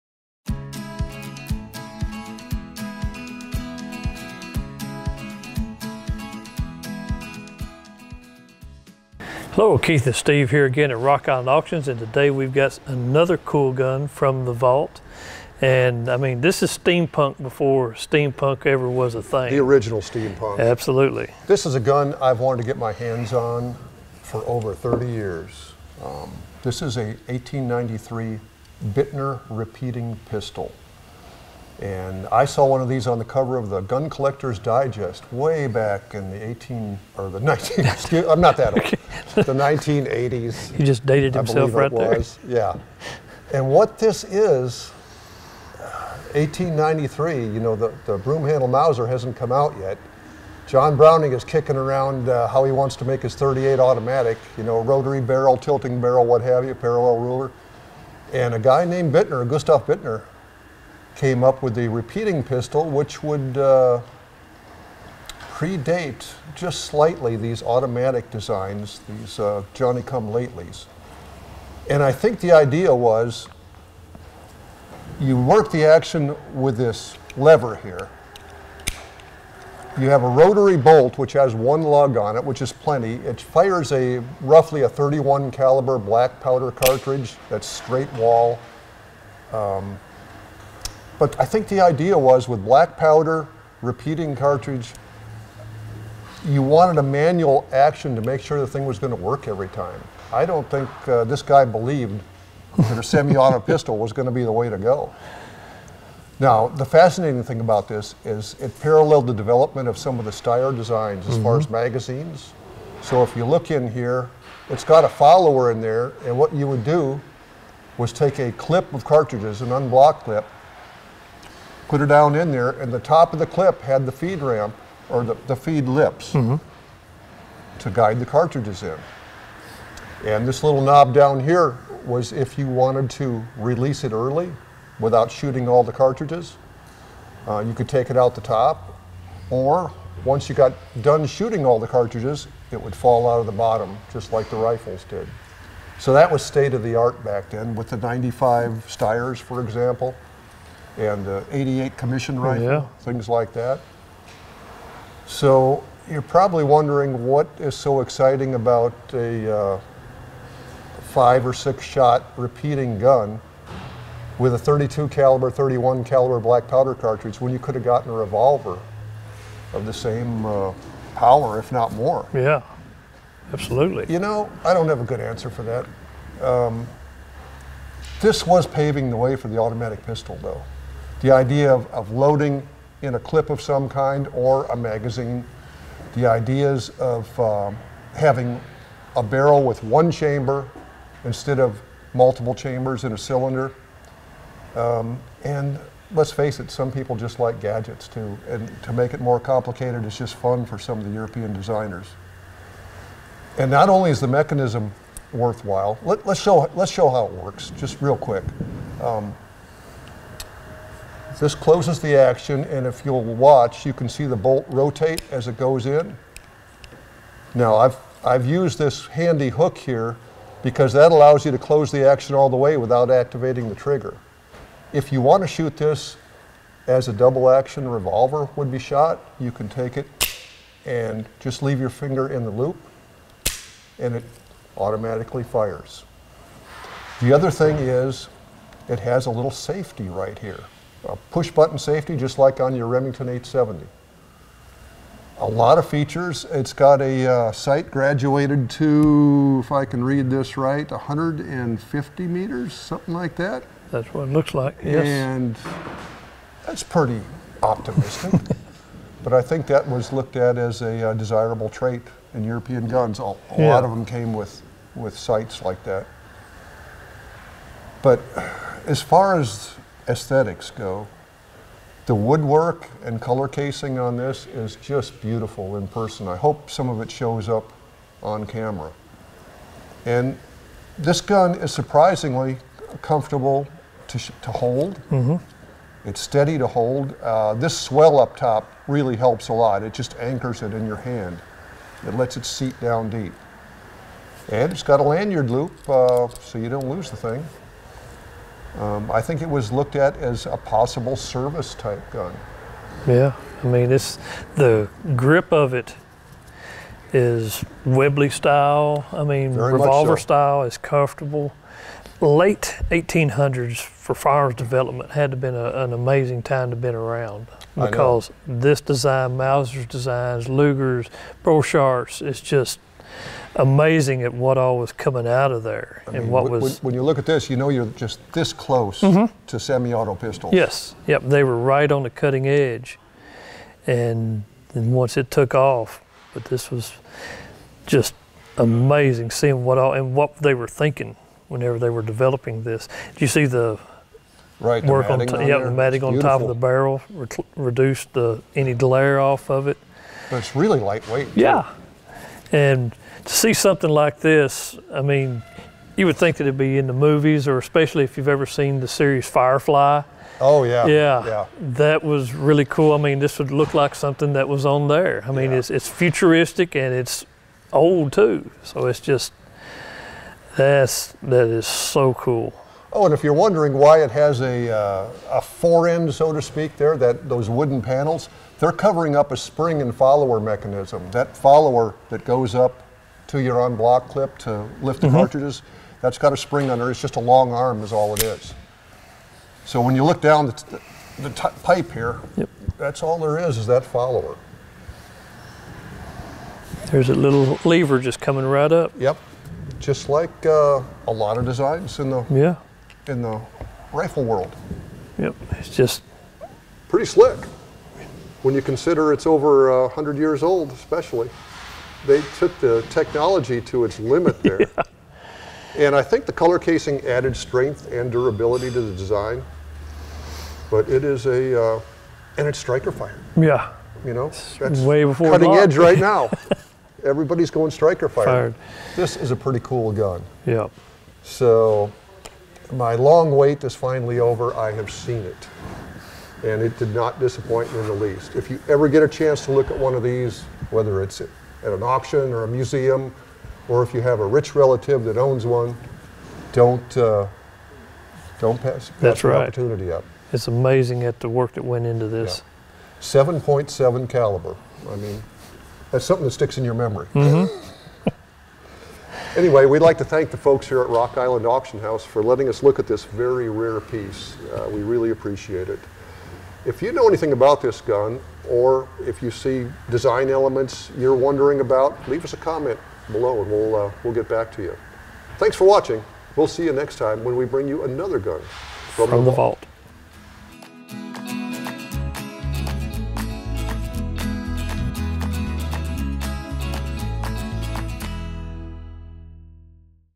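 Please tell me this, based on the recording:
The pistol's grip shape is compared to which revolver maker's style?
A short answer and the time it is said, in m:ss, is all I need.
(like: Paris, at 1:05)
Webley, at 5:07.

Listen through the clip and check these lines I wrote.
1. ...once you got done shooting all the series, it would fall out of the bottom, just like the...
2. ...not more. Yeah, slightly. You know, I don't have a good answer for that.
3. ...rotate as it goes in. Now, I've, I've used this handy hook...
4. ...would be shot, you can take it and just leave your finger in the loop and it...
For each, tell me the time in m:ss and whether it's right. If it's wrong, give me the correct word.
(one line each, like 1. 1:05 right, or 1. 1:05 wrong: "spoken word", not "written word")
1. 2:20 wrong: "cartridges", not "series"
2. 2:51 wrong: "absolutely", not "slightly"
3. 3:34 right
4. 3:48 right.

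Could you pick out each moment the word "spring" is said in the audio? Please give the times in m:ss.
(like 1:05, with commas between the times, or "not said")
6:19, 6:26.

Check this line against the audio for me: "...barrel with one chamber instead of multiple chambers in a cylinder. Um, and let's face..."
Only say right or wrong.
right.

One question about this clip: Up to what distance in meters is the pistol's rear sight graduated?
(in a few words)
150 meters.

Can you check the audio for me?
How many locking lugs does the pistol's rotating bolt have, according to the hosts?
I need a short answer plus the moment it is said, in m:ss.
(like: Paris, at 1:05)
1, at 1:21.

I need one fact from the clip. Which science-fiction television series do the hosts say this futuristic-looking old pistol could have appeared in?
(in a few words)
Firefly.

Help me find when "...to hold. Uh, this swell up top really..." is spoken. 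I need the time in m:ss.
4:46.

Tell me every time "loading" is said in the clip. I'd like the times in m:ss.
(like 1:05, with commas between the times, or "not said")
3:02.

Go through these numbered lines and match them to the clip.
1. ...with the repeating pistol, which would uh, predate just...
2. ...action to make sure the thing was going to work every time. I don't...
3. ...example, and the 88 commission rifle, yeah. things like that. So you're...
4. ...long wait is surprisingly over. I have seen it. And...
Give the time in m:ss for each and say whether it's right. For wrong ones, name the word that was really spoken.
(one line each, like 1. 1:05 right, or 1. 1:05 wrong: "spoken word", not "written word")
1. 1:01 right
2. 1:37 right
3. 2:29 right
4. 7:12 wrong: "finally", not "surprisingly".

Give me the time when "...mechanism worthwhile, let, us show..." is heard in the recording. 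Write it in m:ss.
3:24.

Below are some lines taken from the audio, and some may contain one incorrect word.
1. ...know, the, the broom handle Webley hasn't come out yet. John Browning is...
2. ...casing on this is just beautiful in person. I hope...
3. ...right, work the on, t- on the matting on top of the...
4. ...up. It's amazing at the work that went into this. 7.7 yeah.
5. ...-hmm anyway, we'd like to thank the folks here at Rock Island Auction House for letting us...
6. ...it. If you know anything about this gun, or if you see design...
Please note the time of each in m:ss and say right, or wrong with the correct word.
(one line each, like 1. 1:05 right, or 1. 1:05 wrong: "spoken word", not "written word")
1. 0:47 wrong: "Mauser", not "Webley"
2. 4:33 right
3. 5:44 right
4. 7:29 right
5. 7:37 right
6. 7:45 right.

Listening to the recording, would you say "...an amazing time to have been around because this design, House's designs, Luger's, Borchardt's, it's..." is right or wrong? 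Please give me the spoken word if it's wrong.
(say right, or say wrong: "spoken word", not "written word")
wrong: "Mauser", not "House".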